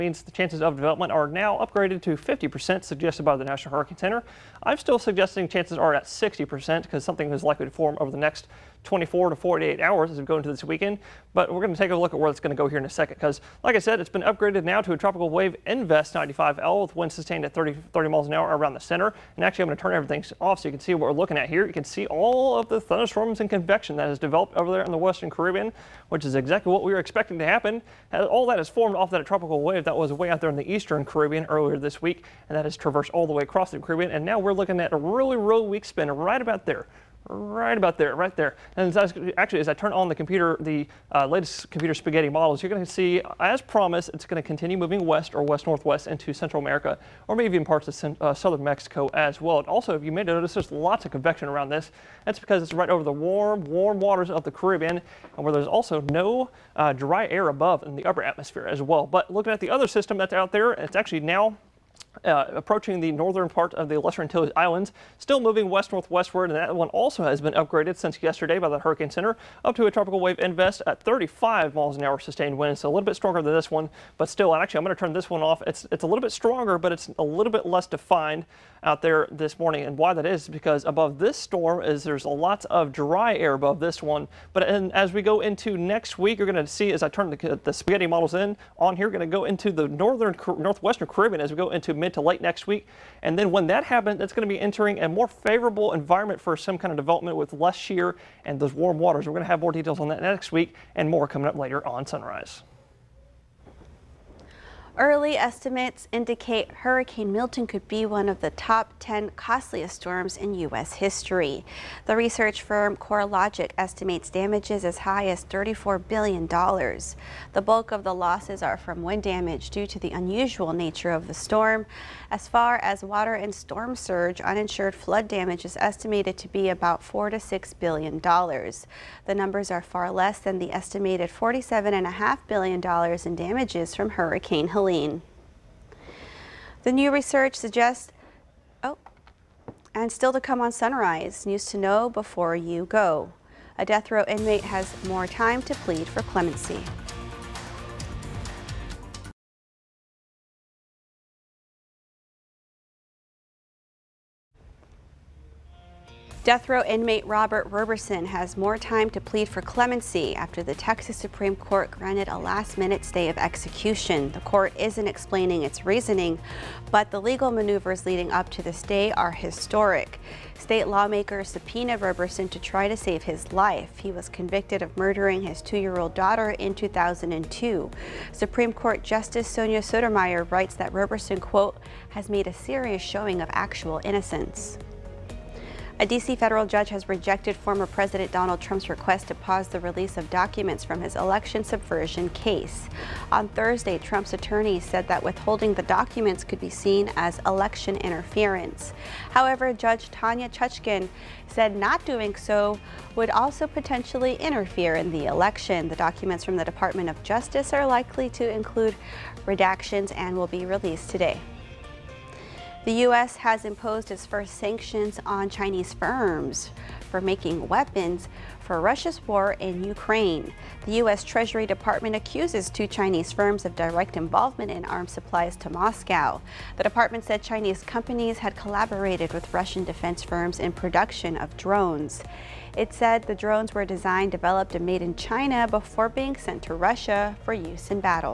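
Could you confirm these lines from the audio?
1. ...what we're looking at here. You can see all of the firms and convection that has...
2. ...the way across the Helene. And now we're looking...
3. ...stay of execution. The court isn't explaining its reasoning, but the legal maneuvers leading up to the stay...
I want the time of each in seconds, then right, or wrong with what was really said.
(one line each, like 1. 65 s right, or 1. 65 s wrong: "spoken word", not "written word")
1. 20 s wrong: "thunderstorms", not "firms"
2. 33 s wrong: "Caribbean", not "Helene"
3. 163 s right.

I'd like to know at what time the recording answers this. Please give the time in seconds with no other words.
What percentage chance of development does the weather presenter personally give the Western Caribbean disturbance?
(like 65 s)
6 s.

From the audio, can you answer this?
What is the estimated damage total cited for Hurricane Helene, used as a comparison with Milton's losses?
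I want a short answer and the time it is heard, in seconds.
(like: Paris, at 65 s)
$47.5 billion, at 131 s.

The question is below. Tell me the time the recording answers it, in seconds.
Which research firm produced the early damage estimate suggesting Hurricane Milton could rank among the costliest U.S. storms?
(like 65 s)
112 s.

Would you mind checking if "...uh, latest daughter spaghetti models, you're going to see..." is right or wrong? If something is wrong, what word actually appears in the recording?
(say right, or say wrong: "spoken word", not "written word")
wrong: "computer", not "daughter".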